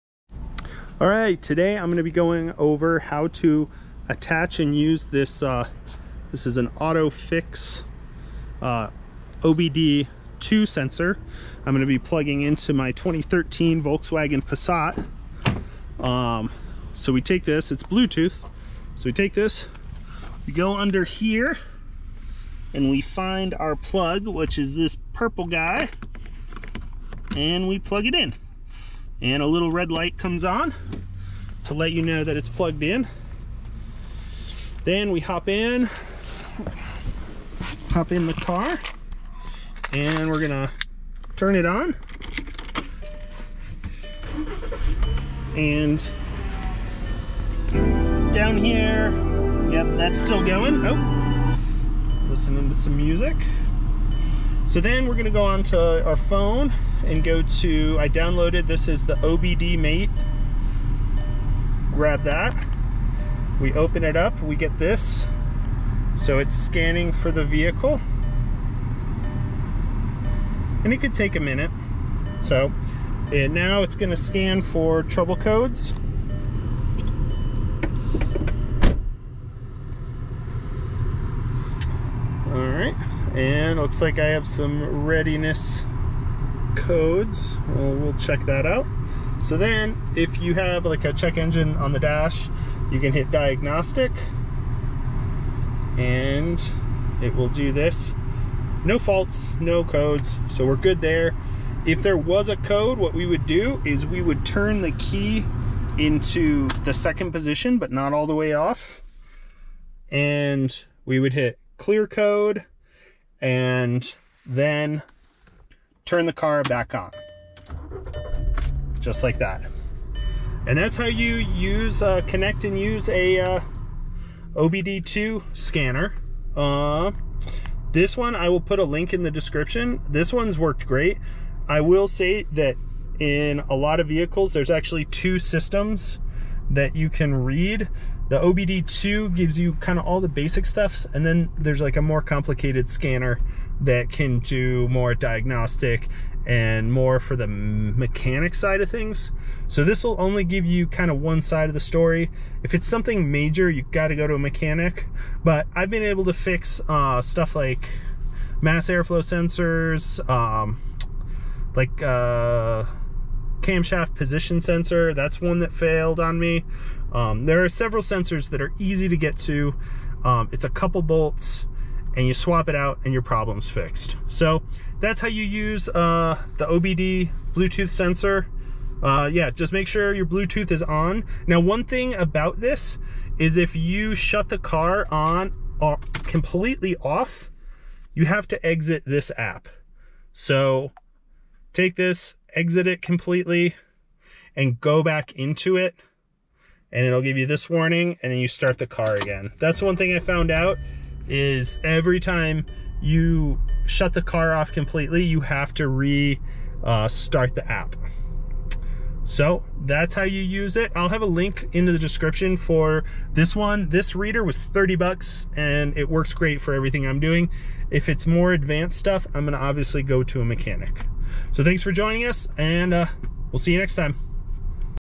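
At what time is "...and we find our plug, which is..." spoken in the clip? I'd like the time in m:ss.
0:22.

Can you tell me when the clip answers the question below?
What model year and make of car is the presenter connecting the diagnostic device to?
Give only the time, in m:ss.
0:12.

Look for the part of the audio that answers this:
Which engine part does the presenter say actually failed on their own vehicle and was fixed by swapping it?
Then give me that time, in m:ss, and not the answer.
2:43.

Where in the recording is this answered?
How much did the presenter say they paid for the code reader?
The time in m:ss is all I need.
3:34.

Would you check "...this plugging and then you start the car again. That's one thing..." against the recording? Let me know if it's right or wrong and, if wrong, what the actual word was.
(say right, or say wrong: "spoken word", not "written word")
wrong: "warning", not "plugging".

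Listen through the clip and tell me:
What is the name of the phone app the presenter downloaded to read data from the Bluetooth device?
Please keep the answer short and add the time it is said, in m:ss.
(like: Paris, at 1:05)
OBD Mate, at 0:59.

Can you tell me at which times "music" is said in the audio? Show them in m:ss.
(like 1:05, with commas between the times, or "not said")
0:52.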